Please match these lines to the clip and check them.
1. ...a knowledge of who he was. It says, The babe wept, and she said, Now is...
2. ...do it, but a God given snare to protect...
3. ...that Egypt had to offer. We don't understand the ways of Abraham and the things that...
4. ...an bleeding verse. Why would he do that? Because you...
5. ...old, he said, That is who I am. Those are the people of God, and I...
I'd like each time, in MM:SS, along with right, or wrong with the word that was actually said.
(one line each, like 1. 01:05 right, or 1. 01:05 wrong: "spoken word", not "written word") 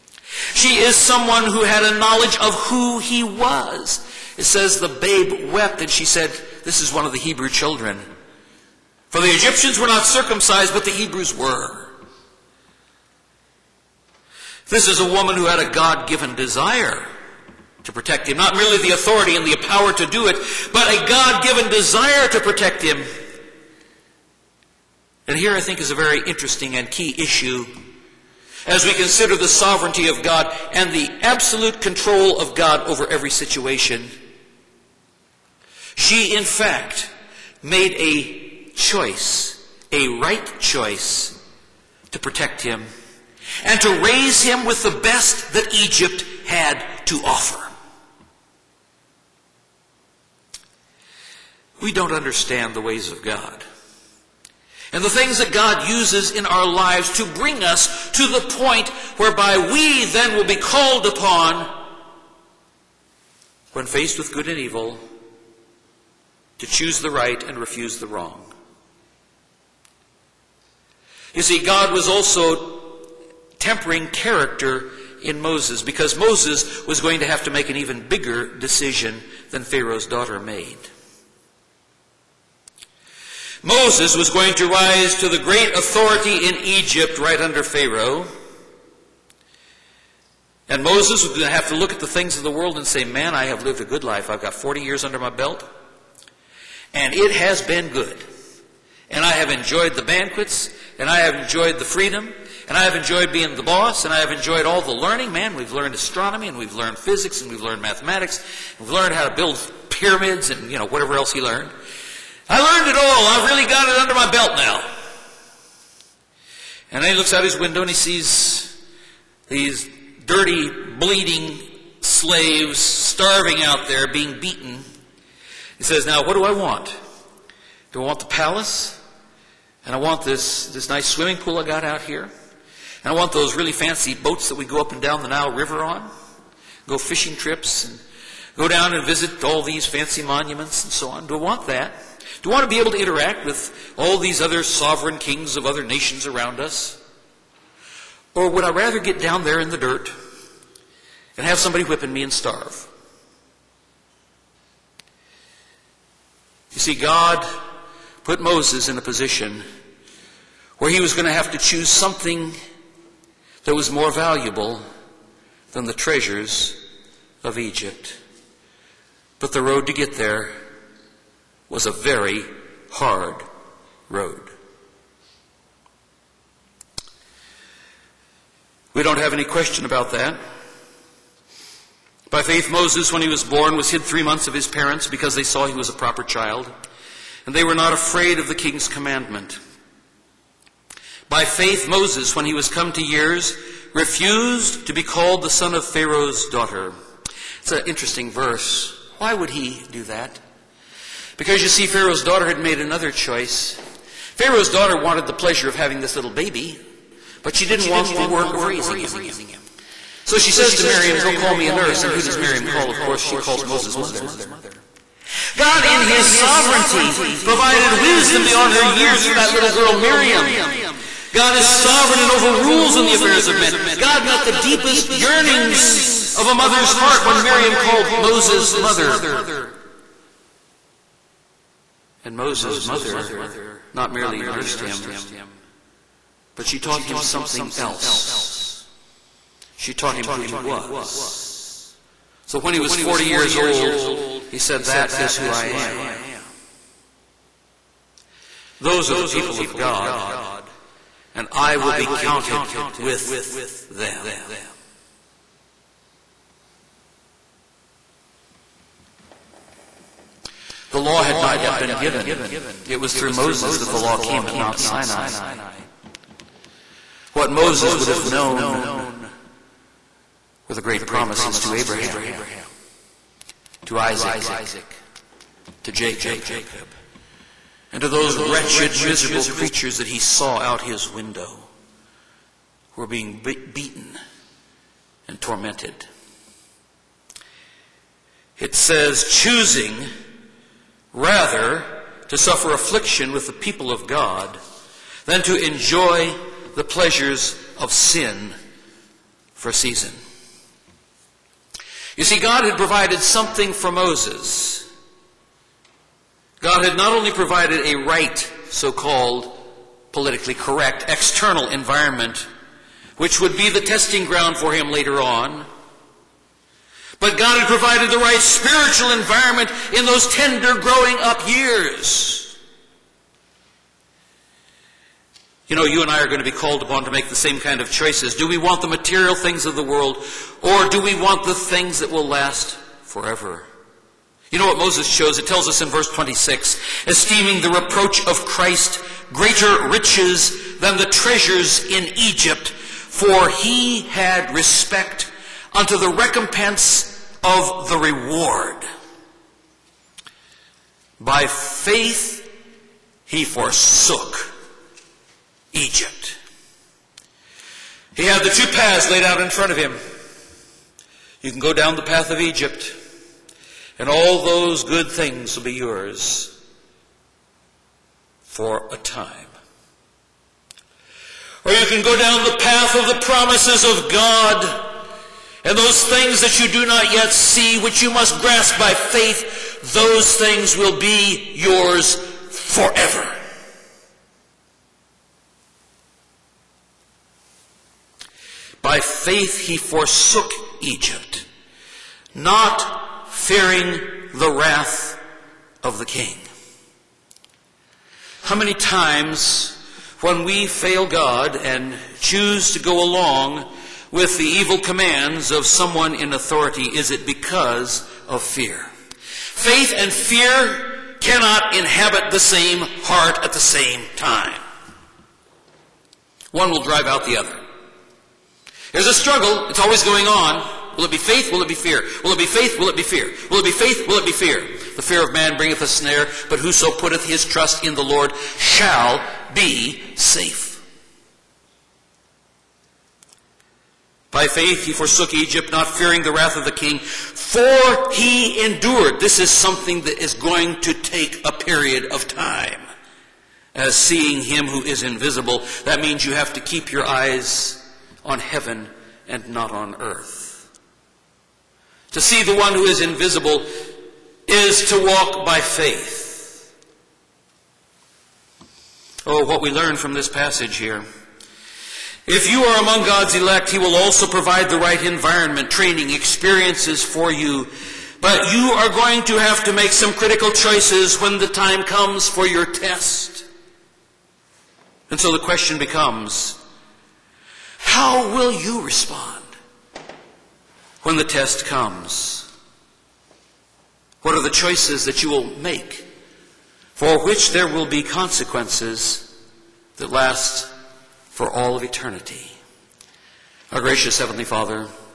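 1. 00:01 wrong: "This", not "Now"
2. 00:20 wrong: "desire", not "snare"
3. 00:45 wrong: "God", not "Abraham"
4. 03:17 wrong: "interesting", not "bleeding"
5. 04:03 right.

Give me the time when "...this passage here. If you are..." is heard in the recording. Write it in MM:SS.
07:40.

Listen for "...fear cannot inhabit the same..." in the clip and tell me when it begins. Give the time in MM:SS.
06:50.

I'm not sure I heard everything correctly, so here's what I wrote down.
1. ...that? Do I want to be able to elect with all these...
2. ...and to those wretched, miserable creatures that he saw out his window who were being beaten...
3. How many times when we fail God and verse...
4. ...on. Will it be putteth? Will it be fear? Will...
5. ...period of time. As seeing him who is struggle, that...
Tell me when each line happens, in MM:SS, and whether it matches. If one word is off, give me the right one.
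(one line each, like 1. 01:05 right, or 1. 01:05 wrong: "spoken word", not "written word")
1. 02:21 wrong: "interact", not "elect"
2. 04:37 right
3. 06:38 wrong: "choose", not "verse"
4. 07:00 wrong: "faith", not "putteth"
5. 07:21 wrong: "invisible", not "struggle".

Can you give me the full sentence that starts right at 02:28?
Or would I rather get down there in the dirt and have somebody whipping me and starve?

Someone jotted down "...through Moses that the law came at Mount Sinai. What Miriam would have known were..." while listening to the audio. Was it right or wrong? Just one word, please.
wrong.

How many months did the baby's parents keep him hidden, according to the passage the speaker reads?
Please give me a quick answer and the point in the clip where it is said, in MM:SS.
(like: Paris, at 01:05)
3, at 03:04.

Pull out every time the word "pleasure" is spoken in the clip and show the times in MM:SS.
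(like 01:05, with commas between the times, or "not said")
03:25, 04:56.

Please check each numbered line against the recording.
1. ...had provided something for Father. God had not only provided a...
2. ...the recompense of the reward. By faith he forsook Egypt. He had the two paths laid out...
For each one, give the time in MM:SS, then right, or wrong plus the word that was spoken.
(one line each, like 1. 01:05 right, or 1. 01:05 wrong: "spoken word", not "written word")
1. 05:02 wrong: "Moses", not "Father"
2. 05:45 right.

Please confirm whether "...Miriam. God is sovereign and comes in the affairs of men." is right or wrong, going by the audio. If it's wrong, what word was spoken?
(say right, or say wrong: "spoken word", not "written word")
wrong: "overrules", not "comes".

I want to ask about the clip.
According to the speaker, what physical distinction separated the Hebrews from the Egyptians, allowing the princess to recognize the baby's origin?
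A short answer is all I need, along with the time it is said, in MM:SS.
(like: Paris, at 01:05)
circumcised, at 00:10.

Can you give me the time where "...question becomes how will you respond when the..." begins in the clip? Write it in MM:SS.
07:55.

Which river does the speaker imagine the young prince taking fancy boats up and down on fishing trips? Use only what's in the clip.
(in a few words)
Nile River.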